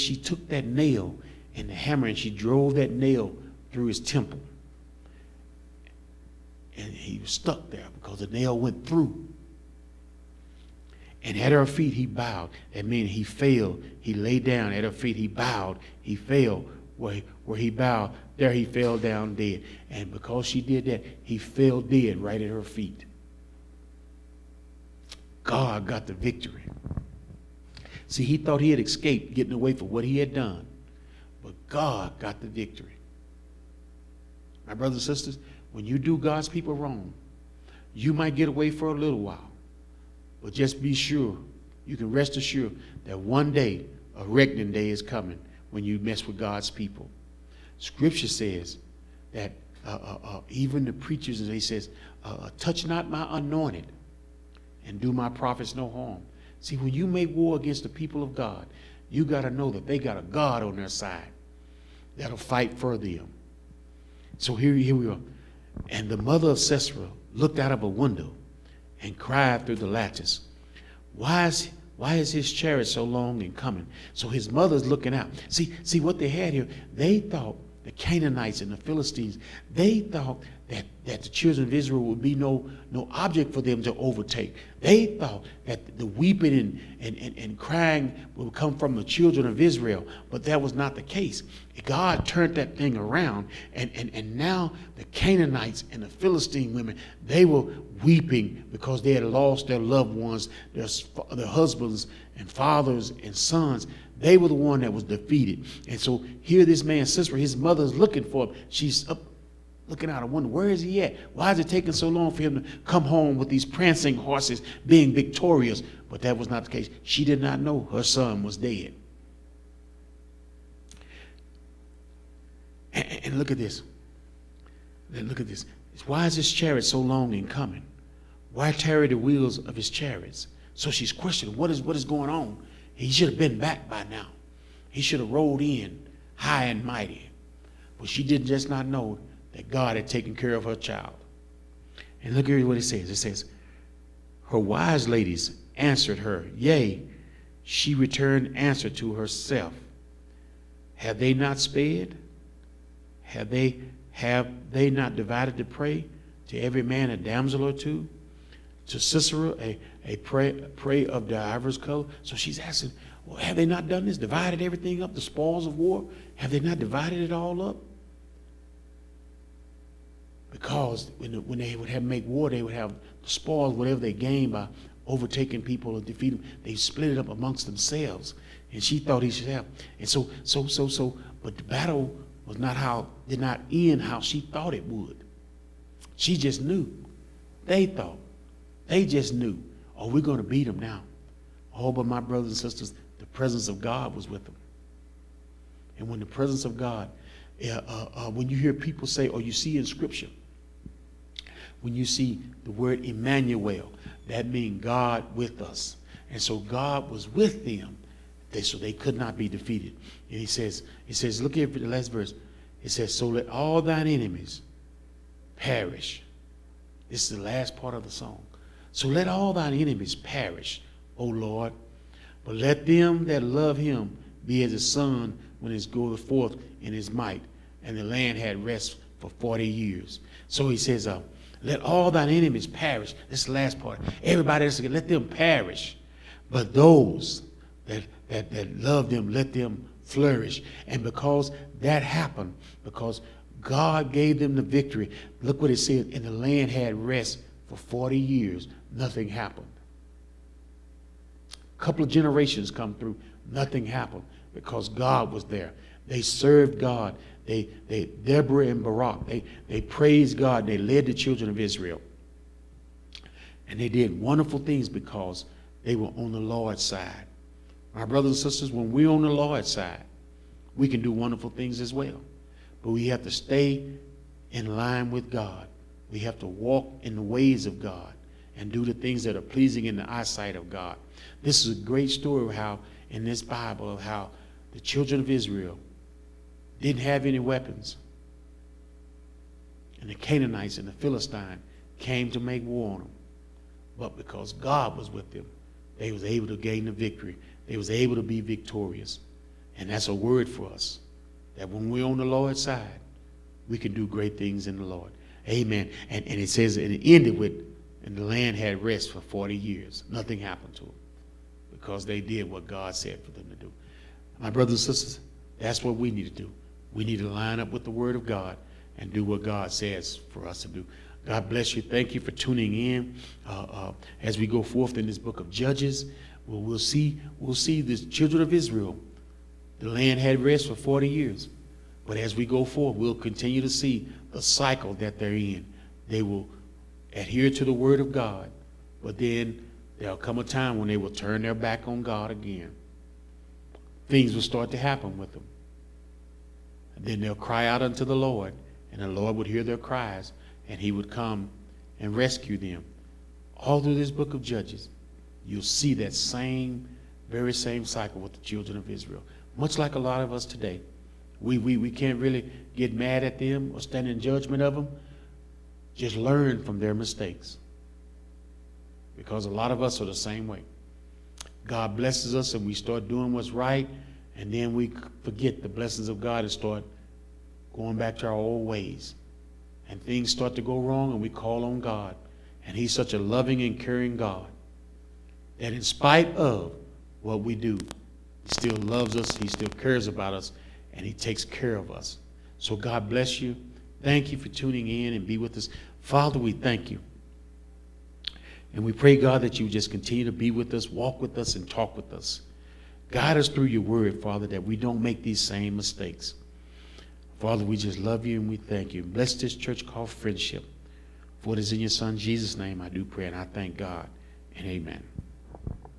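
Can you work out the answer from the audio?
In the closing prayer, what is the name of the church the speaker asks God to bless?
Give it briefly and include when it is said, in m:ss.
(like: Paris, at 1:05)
Friendship, at 6:50.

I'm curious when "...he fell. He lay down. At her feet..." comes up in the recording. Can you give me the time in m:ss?
0:13.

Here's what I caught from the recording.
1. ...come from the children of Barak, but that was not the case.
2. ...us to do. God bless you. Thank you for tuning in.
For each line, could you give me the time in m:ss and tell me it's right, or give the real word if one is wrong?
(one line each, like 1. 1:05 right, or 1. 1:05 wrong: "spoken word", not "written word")
1. 1:28 wrong: "Israel", not "Barak"
2. 5:20 right.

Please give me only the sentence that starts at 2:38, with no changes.
to Sisera a, a prey, prey of divers color.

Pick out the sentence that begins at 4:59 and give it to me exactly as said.
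And that's a word for us, that when we're on the Lord's side, we can do great things in the Lord.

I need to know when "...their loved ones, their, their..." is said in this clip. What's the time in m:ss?
1:39.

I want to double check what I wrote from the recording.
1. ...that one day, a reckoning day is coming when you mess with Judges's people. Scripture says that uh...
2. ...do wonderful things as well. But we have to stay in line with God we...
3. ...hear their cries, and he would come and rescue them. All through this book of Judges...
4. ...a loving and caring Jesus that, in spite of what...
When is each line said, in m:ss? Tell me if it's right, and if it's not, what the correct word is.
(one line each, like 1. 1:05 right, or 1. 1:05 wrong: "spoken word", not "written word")
1. 0:43 wrong: "God", not "Judges"
2. 4:31 right
3. 5:49 right
4. 6:23 wrong: "God", not "Jesus".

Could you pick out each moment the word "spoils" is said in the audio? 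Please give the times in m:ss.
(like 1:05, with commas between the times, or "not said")
2:45, 2:53.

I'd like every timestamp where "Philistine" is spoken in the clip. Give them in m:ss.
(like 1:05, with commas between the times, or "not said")
1:18, 1:36, 4:50.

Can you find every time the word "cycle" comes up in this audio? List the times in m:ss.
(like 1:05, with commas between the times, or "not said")
5:34, 5:57.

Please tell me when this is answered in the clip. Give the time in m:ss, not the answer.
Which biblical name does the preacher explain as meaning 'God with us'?
3:23.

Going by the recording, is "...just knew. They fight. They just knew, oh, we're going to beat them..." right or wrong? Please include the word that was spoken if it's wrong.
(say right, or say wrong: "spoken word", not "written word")
wrong: "thought", not "fight".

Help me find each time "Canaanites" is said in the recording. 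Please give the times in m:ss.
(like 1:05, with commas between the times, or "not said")
1:17, 1:35, 4:50.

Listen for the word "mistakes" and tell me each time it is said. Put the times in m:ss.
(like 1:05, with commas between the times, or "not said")
6:06, 6:45.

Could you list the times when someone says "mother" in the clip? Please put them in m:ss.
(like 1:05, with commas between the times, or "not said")
1:06, 1:14, 1:47.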